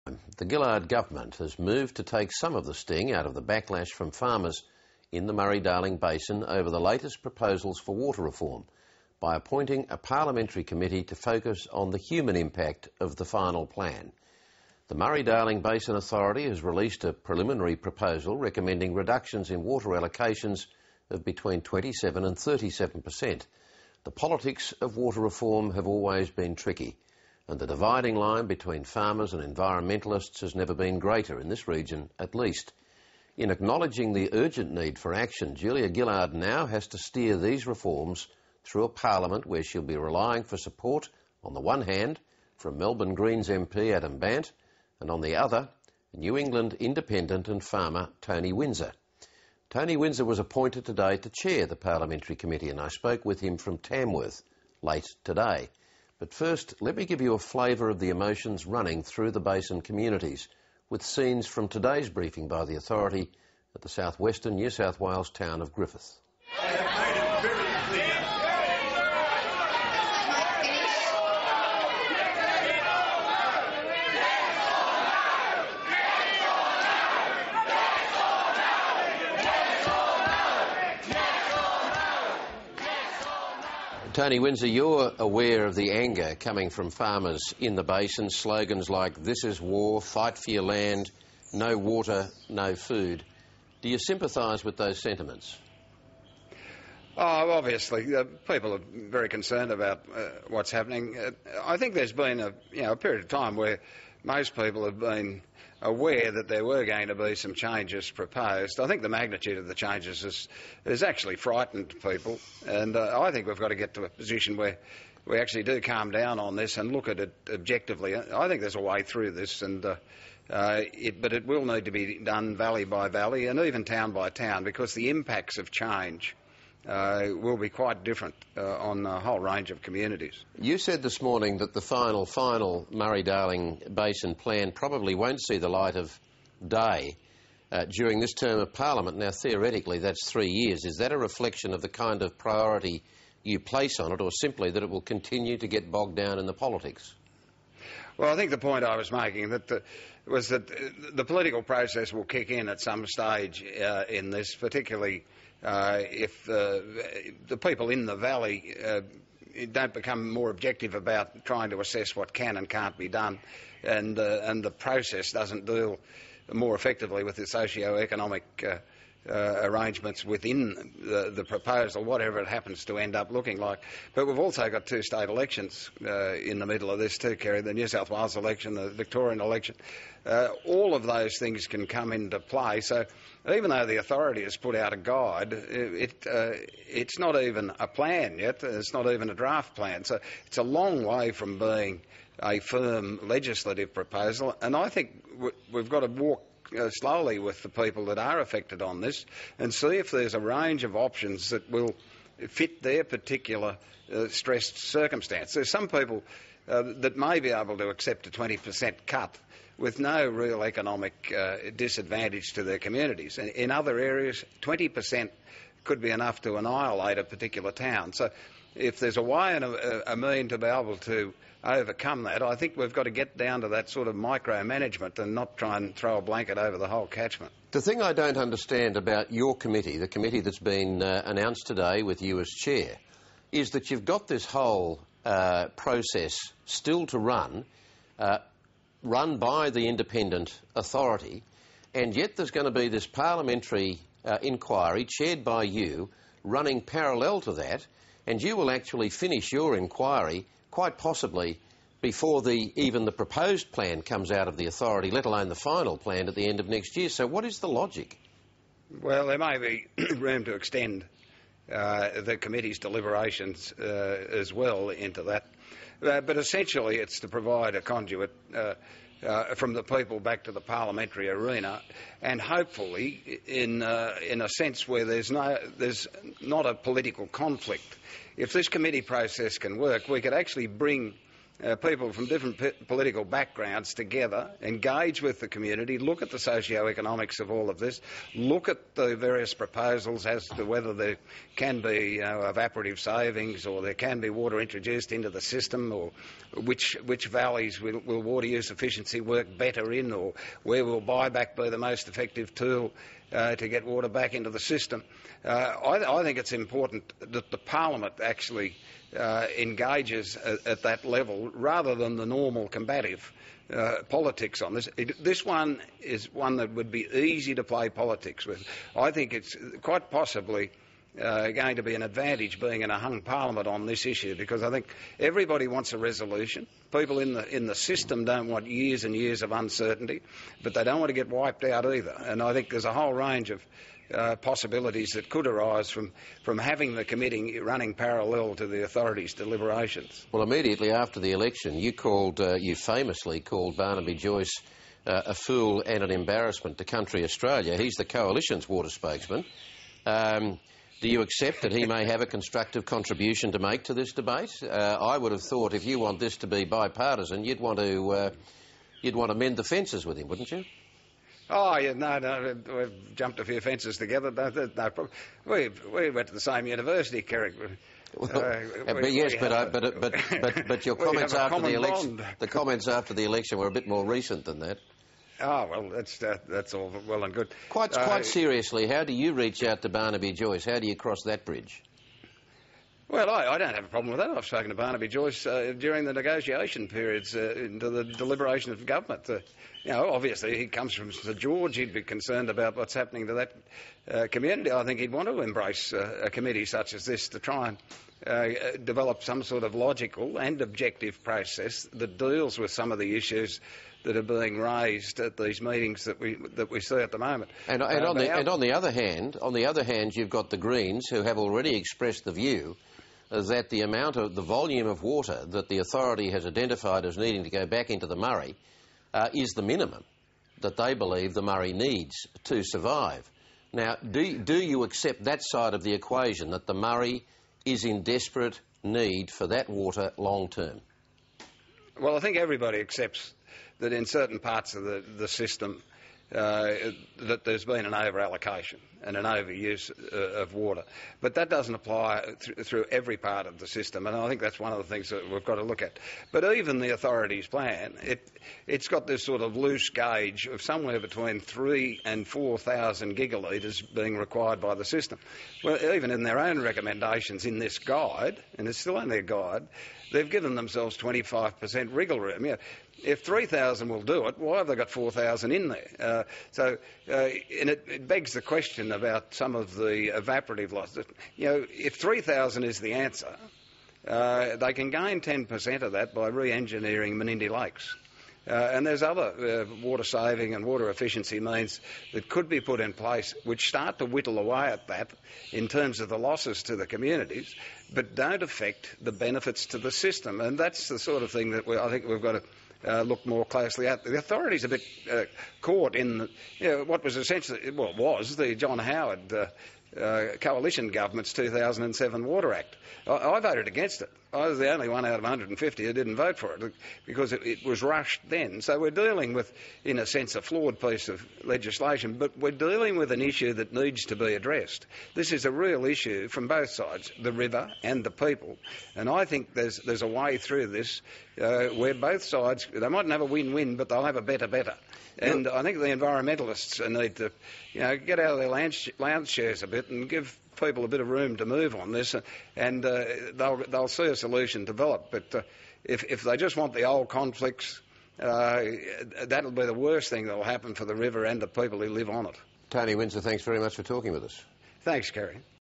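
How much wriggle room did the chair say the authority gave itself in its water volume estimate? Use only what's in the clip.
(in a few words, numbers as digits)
25%.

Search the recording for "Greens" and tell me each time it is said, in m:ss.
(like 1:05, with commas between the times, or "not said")
0:43, 6:50.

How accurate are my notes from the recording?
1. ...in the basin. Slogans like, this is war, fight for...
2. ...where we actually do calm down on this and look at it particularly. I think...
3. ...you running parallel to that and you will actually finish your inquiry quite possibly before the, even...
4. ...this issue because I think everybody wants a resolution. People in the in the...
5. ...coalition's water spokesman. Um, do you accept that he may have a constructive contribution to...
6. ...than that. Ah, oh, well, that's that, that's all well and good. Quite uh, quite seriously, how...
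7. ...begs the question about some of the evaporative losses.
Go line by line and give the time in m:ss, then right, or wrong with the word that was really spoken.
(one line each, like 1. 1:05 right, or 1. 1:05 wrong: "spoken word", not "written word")
1. 1:27 right
2. 1:54 wrong: "objectively", not "particularly"
3. 4:05 right
4. 5:23 right
5. 5:48 right
6. 6:14 right
7. 7:48 right.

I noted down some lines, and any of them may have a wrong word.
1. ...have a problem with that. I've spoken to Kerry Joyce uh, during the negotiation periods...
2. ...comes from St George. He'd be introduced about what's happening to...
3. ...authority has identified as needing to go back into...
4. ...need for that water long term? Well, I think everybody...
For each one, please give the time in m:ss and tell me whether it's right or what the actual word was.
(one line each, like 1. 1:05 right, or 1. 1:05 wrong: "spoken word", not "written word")
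1. 6:23 wrong: "Barnaby", not "Kerry"
2. 6:30 wrong: "concerned", not "introduced"
3. 6:55 right
4. 7:08 right.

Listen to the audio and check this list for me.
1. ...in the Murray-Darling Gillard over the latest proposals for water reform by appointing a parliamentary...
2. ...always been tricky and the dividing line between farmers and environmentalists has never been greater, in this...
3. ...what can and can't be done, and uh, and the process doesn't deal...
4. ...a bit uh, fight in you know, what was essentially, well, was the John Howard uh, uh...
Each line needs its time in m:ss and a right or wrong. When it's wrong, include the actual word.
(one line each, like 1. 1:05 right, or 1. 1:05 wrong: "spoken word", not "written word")
1. 0:05 wrong: "Basin", not "Gillard"
2. 0:25 right
3. 2:42 right
4. 8:14 wrong: "caught", not "fight".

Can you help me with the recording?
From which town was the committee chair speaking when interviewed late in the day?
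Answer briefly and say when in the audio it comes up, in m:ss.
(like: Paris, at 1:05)
Tamworth, at 0:53.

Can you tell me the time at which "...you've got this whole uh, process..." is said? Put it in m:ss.
3:53.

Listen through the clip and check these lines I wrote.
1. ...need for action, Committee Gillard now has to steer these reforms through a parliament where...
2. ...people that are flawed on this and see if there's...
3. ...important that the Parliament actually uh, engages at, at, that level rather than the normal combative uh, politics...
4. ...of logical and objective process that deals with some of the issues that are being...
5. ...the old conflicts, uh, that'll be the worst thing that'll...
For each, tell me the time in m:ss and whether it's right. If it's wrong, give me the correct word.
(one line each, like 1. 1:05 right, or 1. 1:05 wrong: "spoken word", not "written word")
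1. 0:34 wrong: "Julia", not "Committee"
2. 3:17 wrong: "affected", not "flawed"
3. 5:06 right
4. 6:39 right
5. 8:56 right.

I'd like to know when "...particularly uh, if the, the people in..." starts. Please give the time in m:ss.
2:34.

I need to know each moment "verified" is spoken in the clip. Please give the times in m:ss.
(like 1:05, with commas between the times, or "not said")
not said.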